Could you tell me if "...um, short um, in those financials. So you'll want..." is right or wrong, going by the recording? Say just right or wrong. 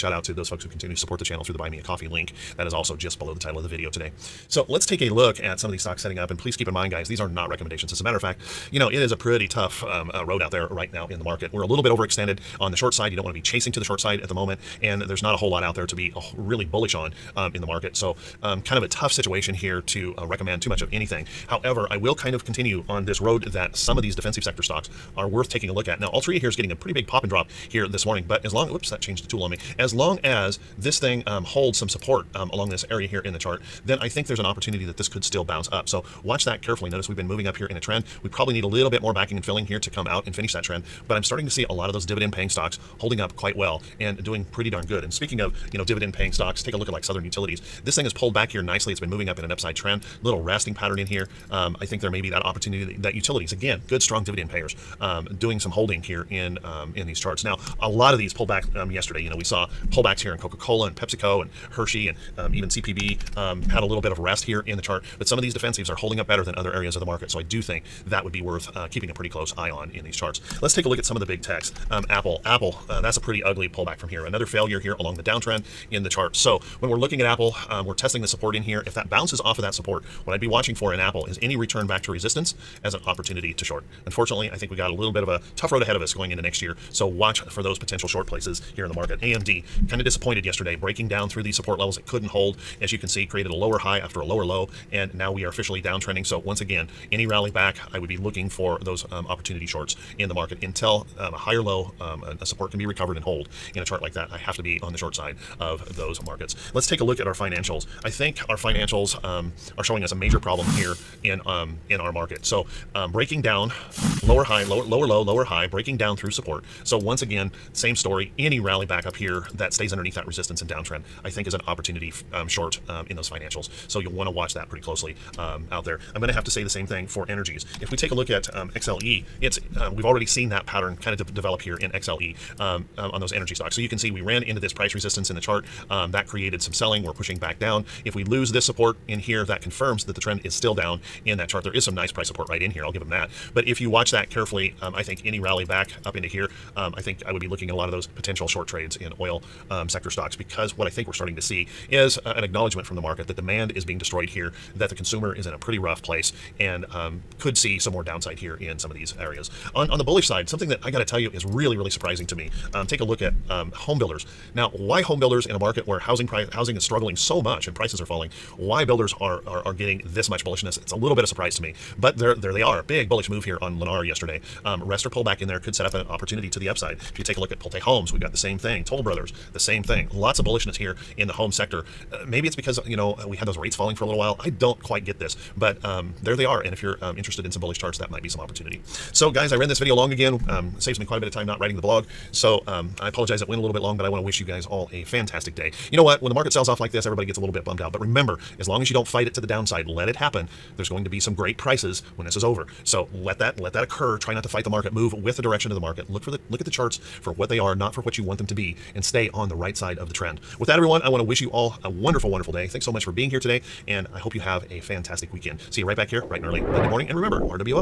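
right.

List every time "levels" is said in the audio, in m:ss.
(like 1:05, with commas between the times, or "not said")
1:31.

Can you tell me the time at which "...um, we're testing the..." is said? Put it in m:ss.
1:17.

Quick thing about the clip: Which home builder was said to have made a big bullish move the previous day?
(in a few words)
Lennar.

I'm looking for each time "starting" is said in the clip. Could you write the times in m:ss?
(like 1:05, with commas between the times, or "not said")
0:41, 2:31.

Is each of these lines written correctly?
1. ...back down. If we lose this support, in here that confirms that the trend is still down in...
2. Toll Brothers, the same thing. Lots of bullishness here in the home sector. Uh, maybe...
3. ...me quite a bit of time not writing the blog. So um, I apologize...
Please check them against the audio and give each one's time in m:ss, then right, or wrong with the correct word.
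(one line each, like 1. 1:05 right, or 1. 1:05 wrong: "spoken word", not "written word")
1. 2:17 right
2. 2:58 right
3. 3:10 right.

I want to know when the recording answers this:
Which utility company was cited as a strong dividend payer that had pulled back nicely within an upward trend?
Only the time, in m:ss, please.
0:47.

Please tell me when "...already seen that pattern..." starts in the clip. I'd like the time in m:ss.
2:10.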